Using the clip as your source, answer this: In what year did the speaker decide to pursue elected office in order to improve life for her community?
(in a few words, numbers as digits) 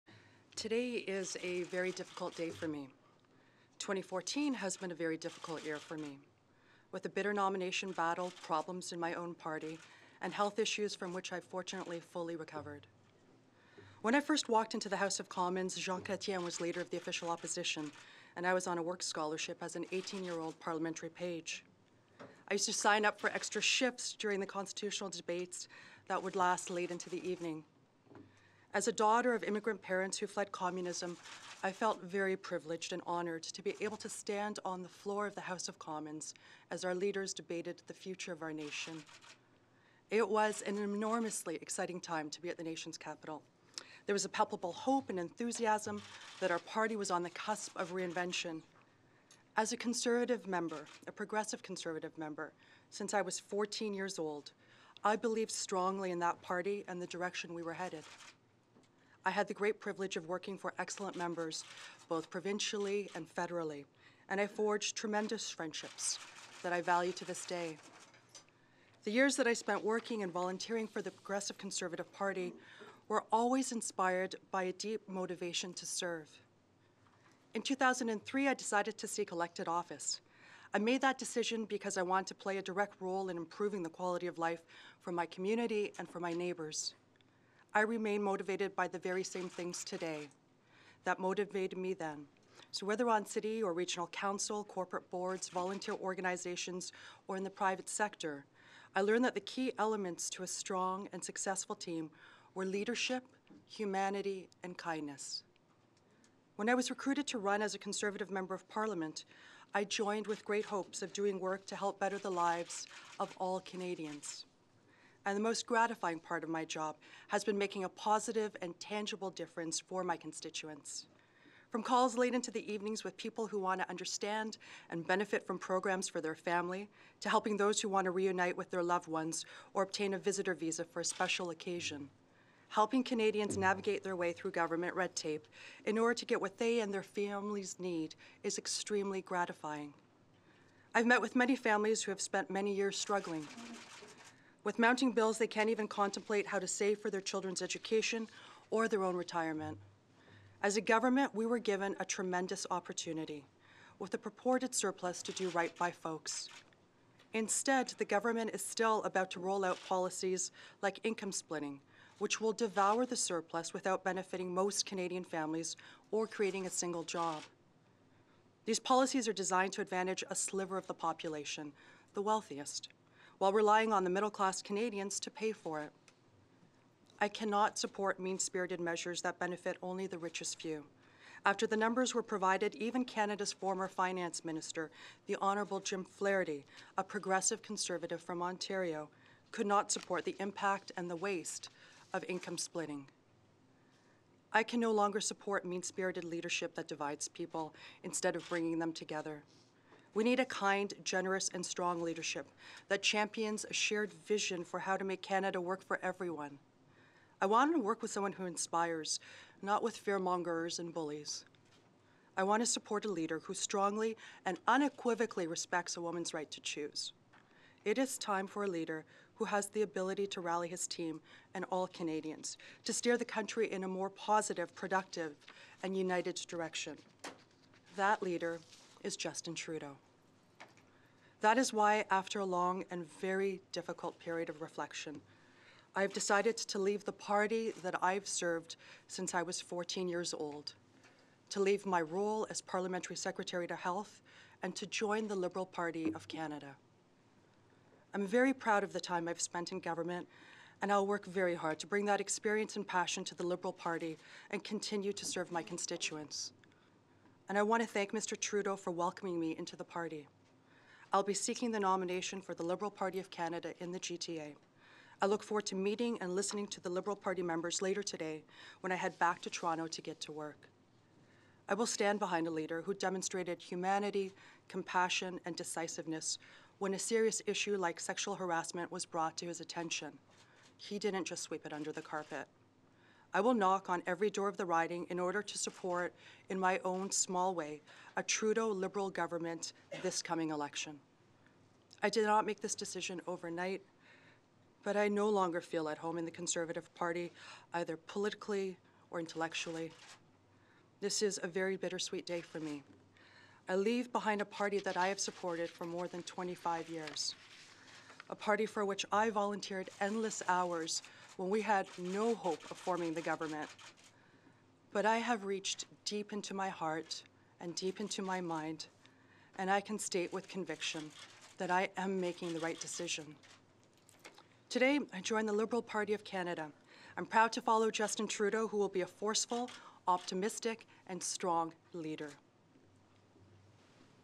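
2003.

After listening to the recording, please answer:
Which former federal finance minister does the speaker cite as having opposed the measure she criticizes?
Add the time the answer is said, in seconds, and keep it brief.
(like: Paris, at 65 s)
Jim Flaherty, at 185 s.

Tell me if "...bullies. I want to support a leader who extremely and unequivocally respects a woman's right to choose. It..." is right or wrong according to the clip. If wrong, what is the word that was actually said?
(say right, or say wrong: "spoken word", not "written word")
wrong: "strongly", not "extremely".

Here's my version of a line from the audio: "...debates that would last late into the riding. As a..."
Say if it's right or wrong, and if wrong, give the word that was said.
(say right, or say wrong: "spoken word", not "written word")
wrong: "evening", not "riding".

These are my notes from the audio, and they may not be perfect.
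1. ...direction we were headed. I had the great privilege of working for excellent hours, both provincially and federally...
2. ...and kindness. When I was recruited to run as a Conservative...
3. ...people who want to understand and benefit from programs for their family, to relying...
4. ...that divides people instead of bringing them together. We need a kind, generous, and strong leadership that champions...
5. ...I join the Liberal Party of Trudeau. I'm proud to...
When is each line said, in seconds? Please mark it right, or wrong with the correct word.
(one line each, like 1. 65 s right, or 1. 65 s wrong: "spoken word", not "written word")
1. 57 s wrong: "members", not "hours"
2. 104 s right
3. 123 s wrong: "helping", not "relying"
4. 196 s right
5. 325 s wrong: "Canada", not "Trudeau".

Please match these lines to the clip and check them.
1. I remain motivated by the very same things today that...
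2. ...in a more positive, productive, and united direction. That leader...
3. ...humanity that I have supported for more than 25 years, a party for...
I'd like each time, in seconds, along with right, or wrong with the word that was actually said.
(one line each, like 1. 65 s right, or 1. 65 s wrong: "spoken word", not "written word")
1. 87 s right
2. 223 s right
3. 304 s wrong: "party", not "humanity".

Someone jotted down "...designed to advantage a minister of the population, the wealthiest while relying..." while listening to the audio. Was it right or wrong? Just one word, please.
wrong.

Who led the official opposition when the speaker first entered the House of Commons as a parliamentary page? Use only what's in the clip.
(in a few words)
Jean Chrétien.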